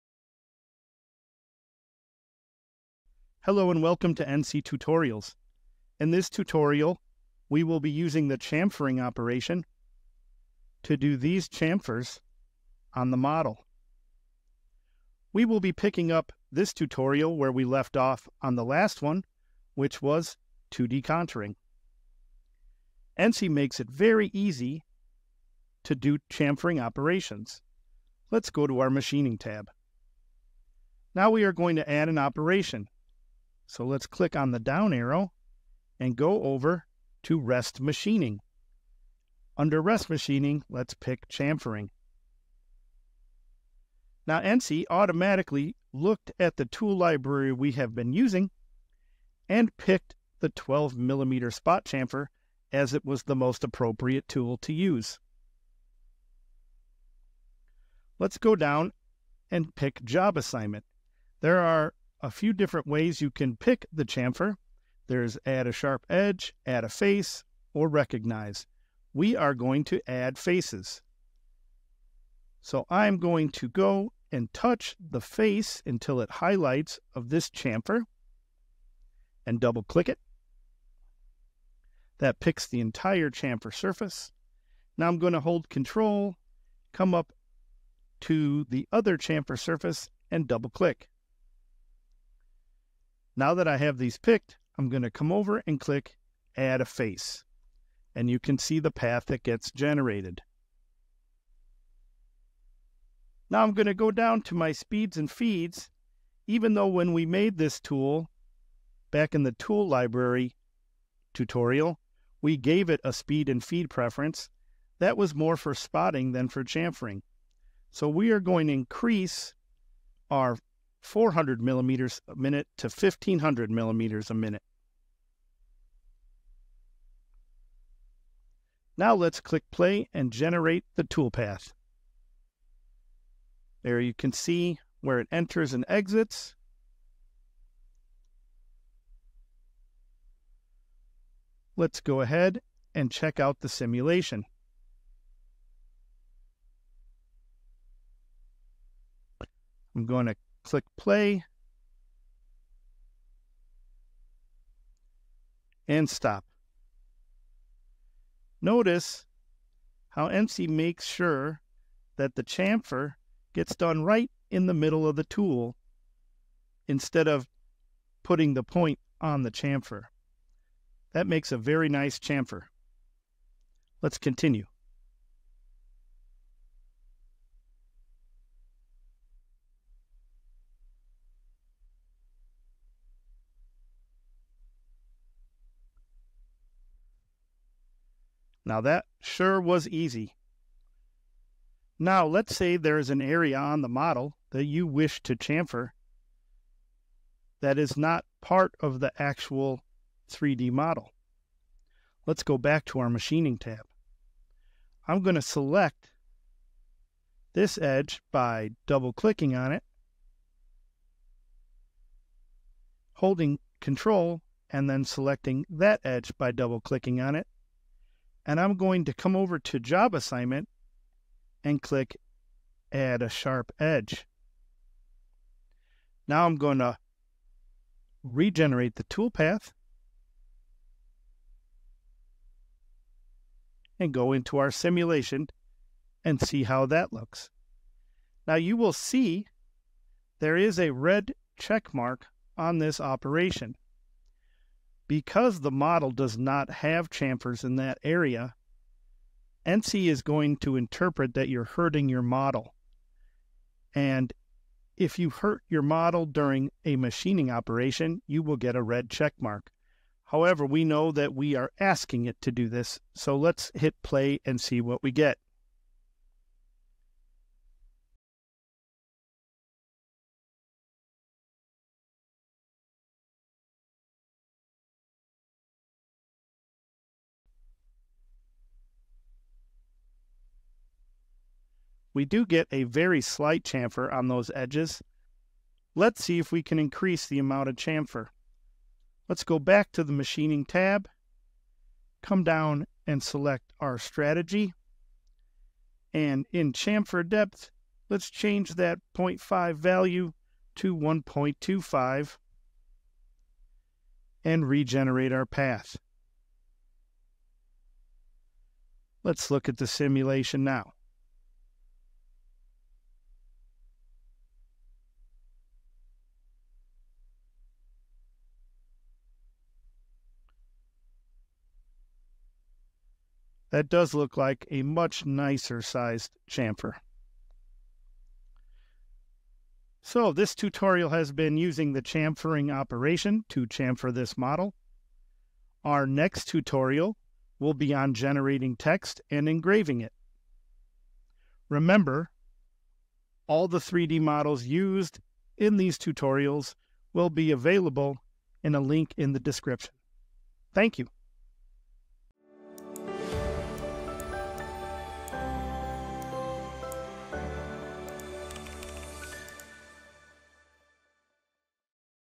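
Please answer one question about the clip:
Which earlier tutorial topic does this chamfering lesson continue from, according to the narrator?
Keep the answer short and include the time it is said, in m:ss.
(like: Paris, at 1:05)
2D contouring, at 0:20.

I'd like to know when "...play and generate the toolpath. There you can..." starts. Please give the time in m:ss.
2:09.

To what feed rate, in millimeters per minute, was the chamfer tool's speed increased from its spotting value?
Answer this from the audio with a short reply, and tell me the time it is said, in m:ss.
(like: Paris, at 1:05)
1500, at 2:02.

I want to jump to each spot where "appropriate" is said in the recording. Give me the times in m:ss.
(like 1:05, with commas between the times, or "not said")
0:53.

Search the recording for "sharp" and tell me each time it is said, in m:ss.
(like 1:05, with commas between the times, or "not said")
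1:05, 3:43.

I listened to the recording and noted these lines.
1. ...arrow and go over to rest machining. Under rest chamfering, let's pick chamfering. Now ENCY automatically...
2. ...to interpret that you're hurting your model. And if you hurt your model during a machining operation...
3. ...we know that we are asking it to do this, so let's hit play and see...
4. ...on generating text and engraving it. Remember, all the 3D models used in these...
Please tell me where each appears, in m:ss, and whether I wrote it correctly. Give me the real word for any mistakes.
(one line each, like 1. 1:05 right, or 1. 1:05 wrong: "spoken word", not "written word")
1. 0:34 wrong: "machining", not "chamfering"
2. 4:10 right
3. 4:20 right
4. 5:37 right.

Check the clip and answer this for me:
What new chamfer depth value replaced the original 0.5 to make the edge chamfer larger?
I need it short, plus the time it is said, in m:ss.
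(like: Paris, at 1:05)
1.25, at 5:00.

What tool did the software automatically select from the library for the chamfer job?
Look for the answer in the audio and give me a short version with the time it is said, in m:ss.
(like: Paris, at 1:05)
12 millimeter spot chamfer, at 0:50.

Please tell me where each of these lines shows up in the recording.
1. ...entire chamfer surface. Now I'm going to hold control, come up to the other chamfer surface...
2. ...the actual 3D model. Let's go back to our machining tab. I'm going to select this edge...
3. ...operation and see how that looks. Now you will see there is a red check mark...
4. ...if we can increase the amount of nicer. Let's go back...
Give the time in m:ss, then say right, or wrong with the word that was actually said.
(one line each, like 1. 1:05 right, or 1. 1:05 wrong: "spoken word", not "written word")
1. 1:22 right
2. 3:19 right
3. 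3:54 wrong: "simulation", not "operation"
4. 4:46 wrong: "chamfer", not "nicer".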